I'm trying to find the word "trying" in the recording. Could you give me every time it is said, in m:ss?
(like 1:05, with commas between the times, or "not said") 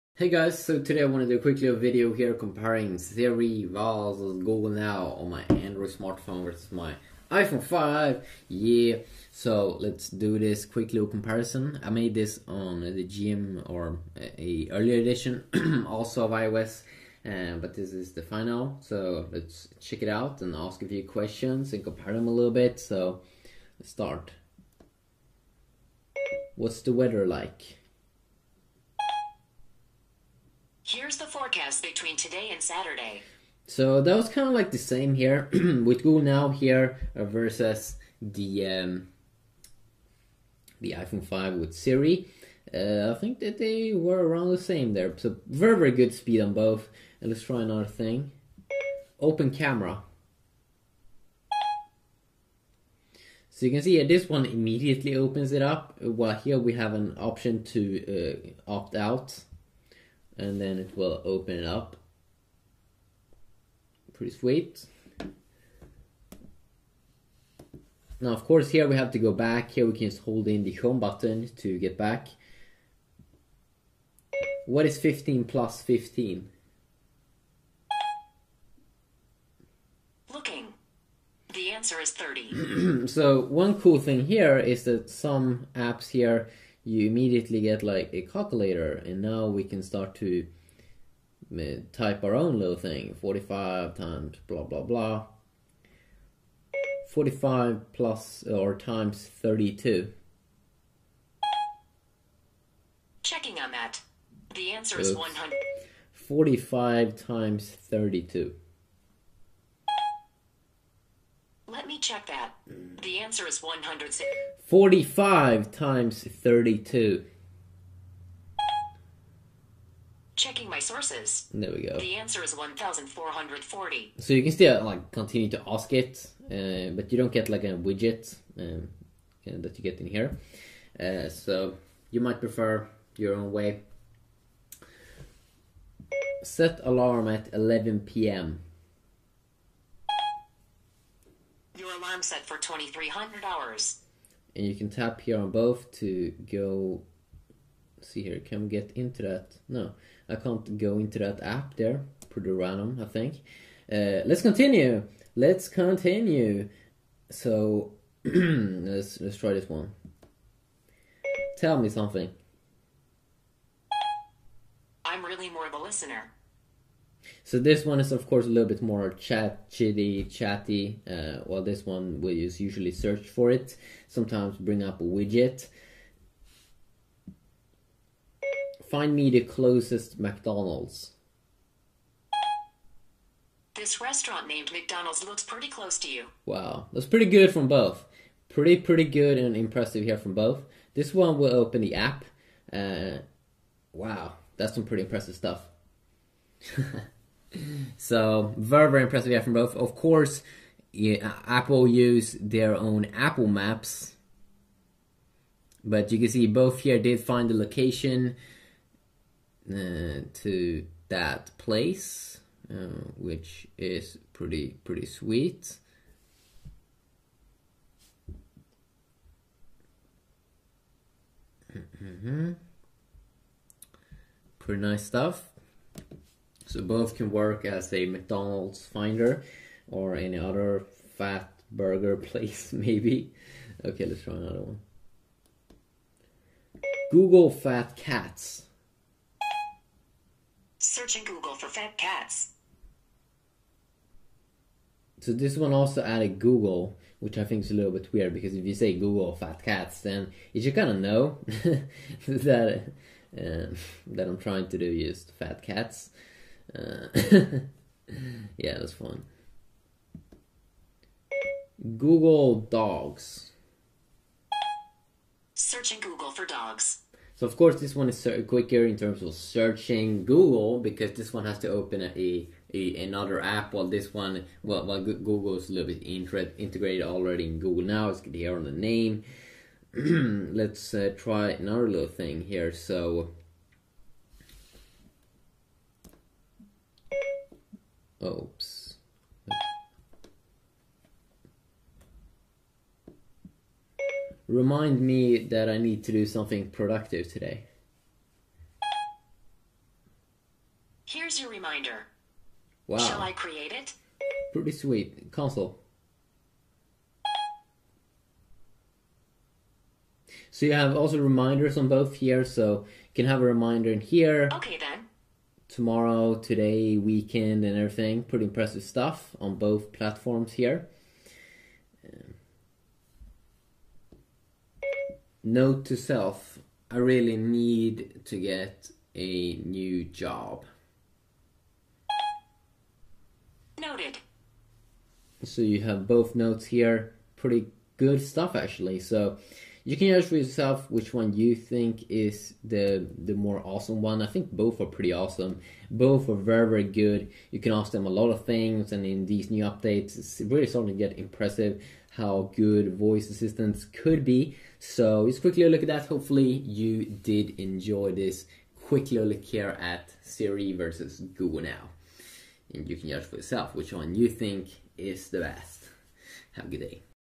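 4:14.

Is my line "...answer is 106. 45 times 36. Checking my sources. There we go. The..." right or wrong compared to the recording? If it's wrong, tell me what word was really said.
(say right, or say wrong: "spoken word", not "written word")
wrong: "32", not "36".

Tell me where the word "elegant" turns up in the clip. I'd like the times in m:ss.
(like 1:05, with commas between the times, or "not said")
not said.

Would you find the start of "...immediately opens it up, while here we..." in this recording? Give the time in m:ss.
0:54.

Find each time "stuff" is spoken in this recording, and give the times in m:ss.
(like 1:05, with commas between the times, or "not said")
3:15, 3:45, 5:18, 5:38.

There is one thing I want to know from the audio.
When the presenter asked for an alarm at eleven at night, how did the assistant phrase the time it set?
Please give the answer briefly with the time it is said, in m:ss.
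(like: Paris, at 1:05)
2300 hours, at 2:22.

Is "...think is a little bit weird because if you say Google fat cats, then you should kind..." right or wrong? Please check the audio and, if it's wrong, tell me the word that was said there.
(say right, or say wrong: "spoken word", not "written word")
right.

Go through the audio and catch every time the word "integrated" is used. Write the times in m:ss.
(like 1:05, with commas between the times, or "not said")
4:36.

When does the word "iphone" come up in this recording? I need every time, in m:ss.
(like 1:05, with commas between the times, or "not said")
0:07, 0:40.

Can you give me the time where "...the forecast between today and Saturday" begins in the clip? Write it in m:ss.
0:31.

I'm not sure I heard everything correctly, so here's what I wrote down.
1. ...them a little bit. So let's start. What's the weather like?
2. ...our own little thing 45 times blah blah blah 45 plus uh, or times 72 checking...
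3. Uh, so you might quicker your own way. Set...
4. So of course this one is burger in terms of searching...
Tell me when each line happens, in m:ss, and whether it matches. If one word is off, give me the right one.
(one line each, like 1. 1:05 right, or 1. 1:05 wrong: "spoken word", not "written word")
1. 0:22 right
2. 1:32 wrong: "32", not "72"
3. 2:10 wrong: "prefer", not "quicker"
4. 4:27 wrong: "quicker", not "burger".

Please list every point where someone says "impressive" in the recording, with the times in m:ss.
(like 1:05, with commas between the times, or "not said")
3:09, 3:15, 3:19, 5:18, 5:51.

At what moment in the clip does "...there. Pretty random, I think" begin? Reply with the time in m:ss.
2:31.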